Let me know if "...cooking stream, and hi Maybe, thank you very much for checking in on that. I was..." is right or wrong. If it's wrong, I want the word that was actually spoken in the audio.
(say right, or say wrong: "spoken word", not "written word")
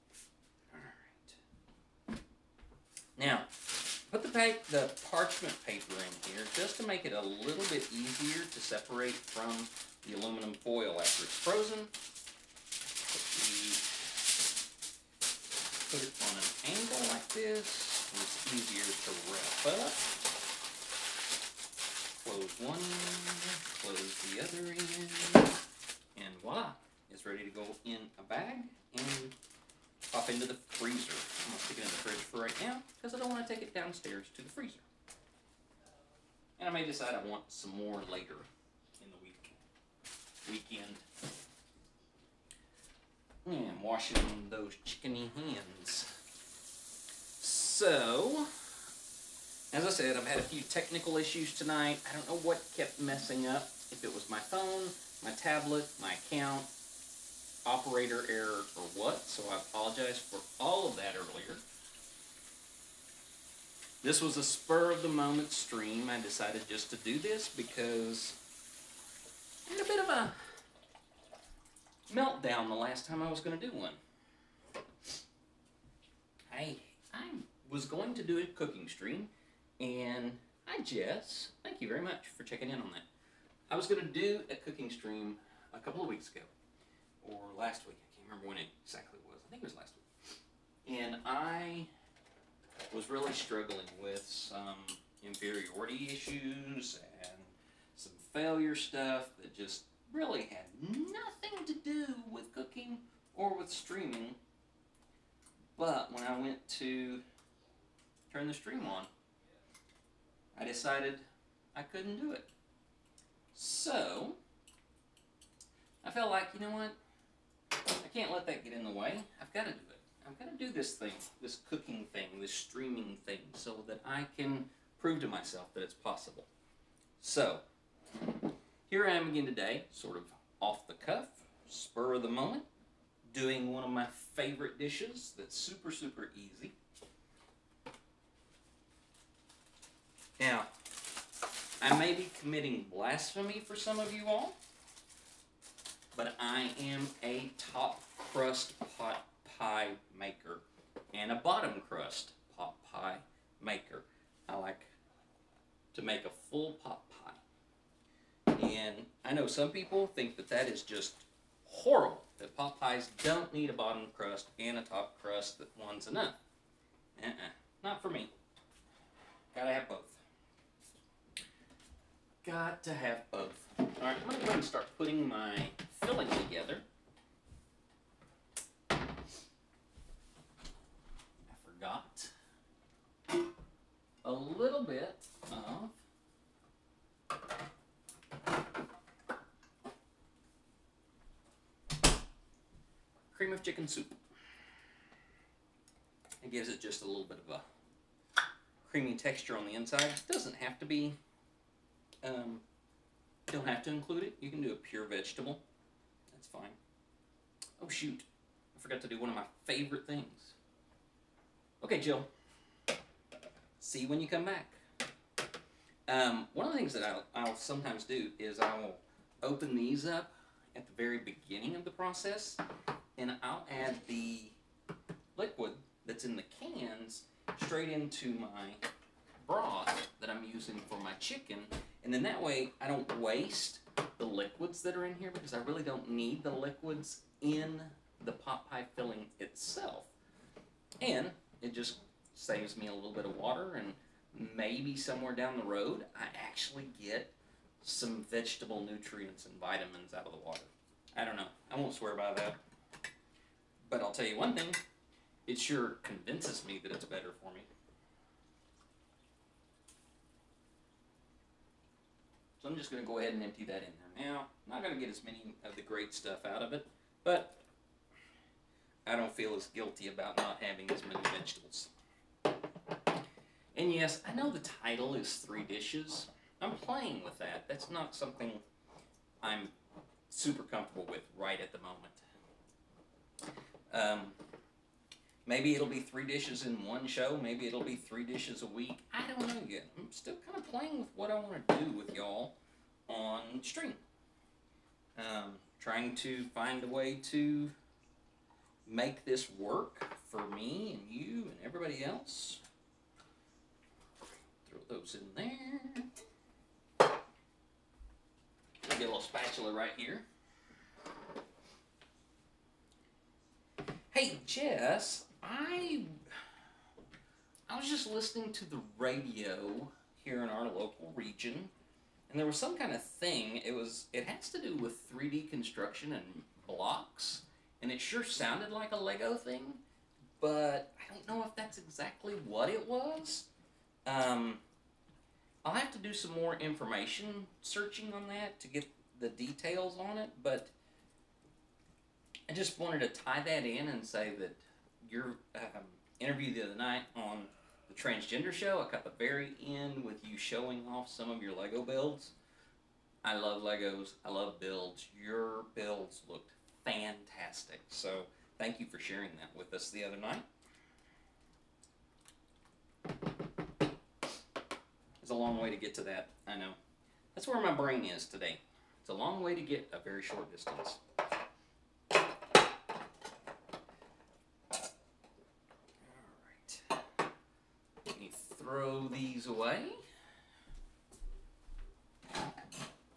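wrong: "Jess", not "Maybe".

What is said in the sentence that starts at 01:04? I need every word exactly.
This was a spur of the moment stream.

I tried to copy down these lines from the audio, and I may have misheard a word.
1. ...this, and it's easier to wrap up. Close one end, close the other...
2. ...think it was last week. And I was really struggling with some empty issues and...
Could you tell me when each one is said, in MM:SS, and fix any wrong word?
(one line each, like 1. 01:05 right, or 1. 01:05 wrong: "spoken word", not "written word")
1. 00:17 right
2. 01:29 wrong: "inferiority", not "empty".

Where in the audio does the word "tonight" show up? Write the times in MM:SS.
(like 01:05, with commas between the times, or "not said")
00:51.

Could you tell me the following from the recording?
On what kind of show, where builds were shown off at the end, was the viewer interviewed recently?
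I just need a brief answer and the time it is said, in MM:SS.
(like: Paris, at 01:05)
transgender show, at 05:47.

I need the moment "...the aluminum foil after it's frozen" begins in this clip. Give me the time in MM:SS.
00:10.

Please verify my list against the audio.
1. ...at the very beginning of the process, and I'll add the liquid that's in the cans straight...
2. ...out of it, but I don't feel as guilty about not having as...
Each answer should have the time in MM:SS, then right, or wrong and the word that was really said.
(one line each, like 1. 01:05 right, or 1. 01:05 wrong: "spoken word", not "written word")
1. 03:40 right
2. 04:26 right.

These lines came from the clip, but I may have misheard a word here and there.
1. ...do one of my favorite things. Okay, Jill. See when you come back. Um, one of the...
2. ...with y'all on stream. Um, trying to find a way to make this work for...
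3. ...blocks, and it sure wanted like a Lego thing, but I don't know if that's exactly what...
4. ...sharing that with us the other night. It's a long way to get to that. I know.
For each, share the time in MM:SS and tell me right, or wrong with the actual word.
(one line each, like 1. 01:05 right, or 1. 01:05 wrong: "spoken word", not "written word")
1. 03:29 right
2. 04:51 right
3. 05:26 wrong: "sounded", not "wanted"
4. 05:58 right.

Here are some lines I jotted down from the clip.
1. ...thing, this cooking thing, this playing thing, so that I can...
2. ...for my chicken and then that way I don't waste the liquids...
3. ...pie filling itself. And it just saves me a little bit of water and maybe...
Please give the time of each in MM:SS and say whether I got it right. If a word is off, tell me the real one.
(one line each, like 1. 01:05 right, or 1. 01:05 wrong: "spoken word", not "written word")
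1. 02:00 wrong: "streaming", not "playing"
2. 03:50 right
3. 03:58 right.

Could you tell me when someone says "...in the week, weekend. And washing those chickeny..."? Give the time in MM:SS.
00:39.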